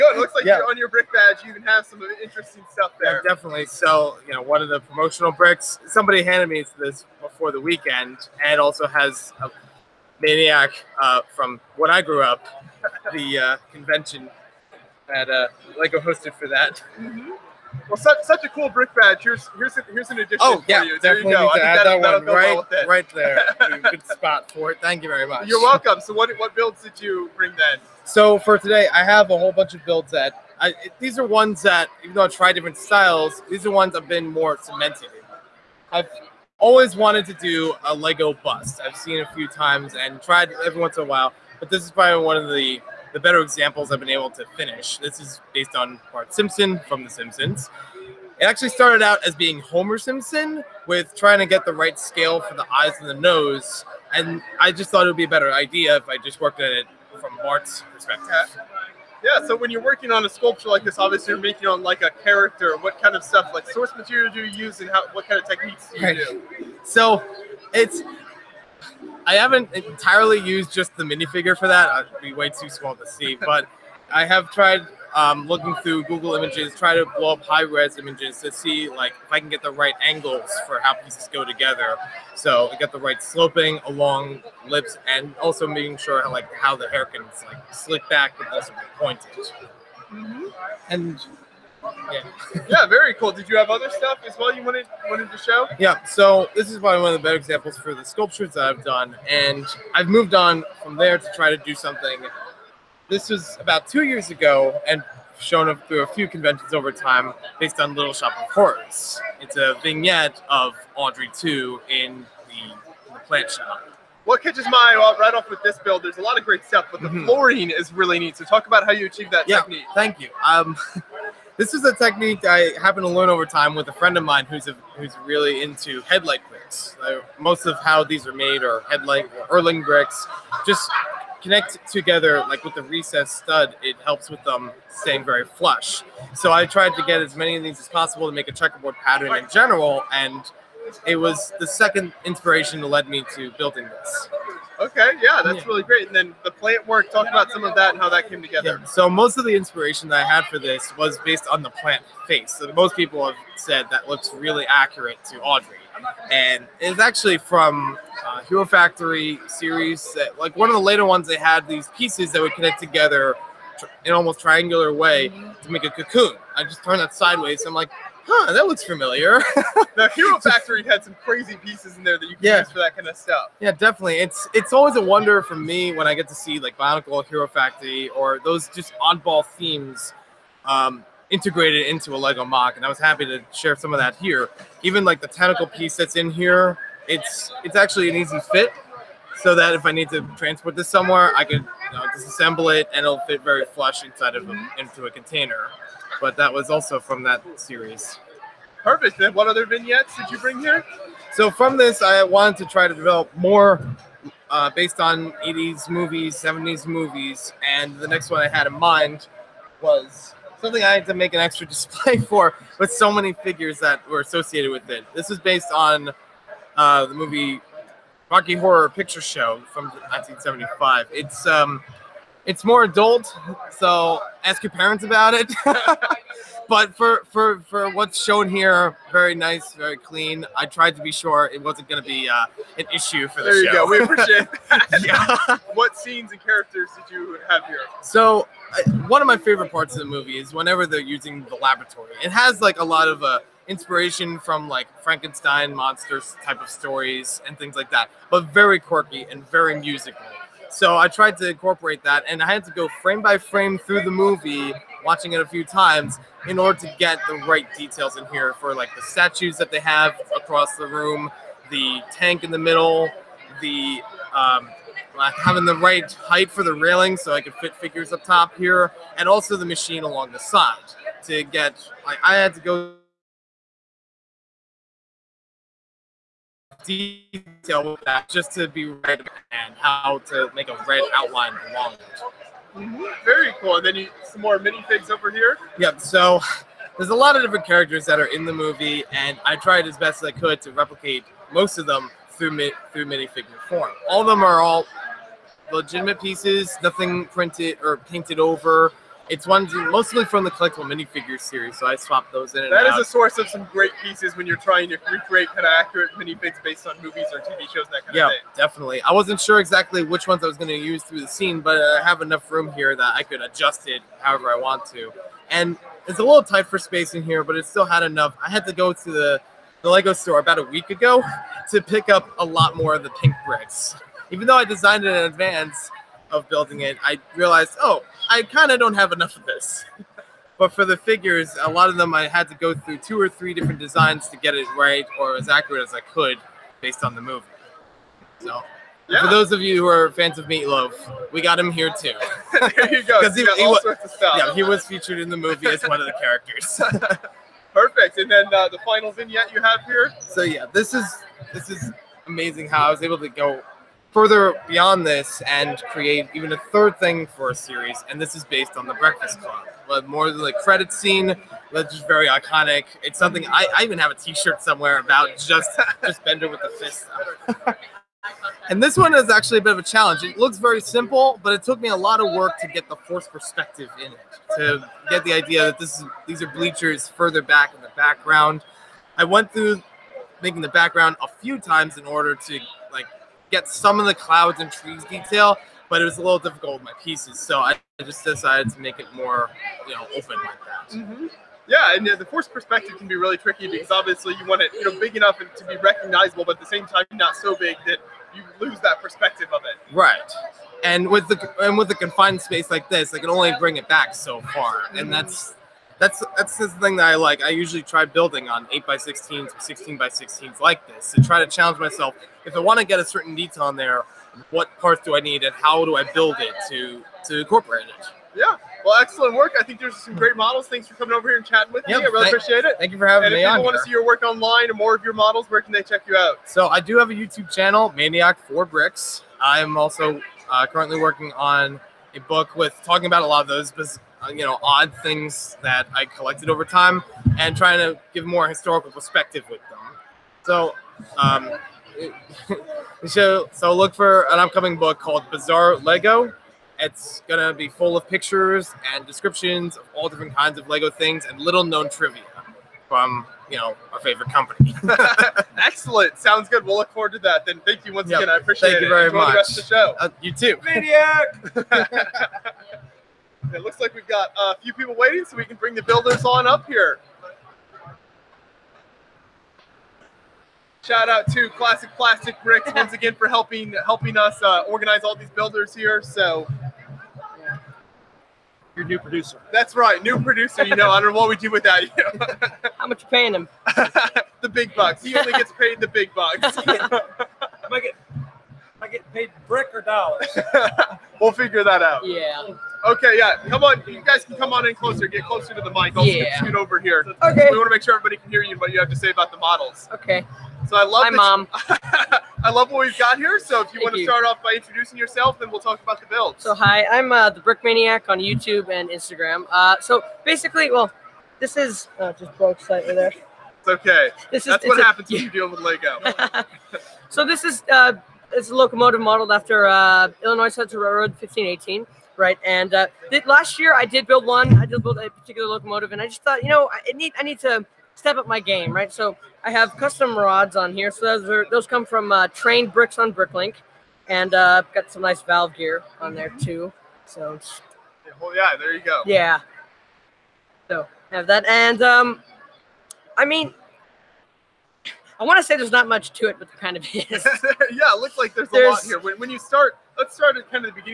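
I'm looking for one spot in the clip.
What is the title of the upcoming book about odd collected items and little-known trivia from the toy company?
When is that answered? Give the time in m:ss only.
7:25.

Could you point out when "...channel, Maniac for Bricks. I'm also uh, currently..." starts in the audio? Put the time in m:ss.
7:07.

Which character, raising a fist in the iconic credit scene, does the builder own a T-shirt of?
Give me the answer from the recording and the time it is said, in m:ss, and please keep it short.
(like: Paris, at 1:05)
Bender, at 6:06.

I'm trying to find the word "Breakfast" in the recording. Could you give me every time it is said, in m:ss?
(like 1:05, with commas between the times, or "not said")
5:58.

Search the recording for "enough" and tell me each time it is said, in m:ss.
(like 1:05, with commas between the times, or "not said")
5:12, 5:18, 5:29, 6:35.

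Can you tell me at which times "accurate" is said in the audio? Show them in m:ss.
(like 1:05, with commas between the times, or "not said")
2:34, 5:05, 5:35.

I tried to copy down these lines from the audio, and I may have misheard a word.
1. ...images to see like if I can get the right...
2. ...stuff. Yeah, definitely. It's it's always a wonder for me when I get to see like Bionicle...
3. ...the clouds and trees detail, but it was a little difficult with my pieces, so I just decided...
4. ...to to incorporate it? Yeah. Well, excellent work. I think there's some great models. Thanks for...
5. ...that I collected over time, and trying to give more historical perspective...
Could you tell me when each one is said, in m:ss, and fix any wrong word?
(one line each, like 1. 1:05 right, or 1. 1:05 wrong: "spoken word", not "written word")
1. 1:17 right
2. 2:53 right
3. 6:24 right
4. 6:56 right
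5. 7:15 right.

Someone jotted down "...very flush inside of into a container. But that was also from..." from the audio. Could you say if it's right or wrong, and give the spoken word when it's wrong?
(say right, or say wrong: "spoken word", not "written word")
right.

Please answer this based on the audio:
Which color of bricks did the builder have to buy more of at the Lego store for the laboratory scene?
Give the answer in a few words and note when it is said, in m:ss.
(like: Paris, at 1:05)
pink, at 5:23.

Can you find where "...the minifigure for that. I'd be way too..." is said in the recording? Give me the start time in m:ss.
1:10.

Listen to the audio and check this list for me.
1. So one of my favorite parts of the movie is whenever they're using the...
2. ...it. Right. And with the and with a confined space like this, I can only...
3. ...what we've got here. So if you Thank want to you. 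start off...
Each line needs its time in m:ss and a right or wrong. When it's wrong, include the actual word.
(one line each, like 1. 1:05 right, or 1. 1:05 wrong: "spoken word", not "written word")
1. 3:58 right
2. 6:39 right
3. 8:22 right.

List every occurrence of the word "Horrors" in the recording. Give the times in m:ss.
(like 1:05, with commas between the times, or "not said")
1:48, 3:38.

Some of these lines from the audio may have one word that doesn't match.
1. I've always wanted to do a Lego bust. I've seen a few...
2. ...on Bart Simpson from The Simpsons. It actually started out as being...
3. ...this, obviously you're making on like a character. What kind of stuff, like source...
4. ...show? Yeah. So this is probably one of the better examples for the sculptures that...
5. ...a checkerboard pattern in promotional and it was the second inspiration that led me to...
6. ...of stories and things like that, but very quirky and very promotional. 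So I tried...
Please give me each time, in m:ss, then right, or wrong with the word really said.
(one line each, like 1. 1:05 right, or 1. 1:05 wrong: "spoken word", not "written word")
1. 0:35 right
2. 0:45 right
3. 1:00 right
4. 1:35 right
5. 2:18 wrong: "general", not "promotional"
6. 4:06 wrong: "musical", not "promotional".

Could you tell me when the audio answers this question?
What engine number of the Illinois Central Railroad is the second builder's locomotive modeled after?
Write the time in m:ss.
8:41.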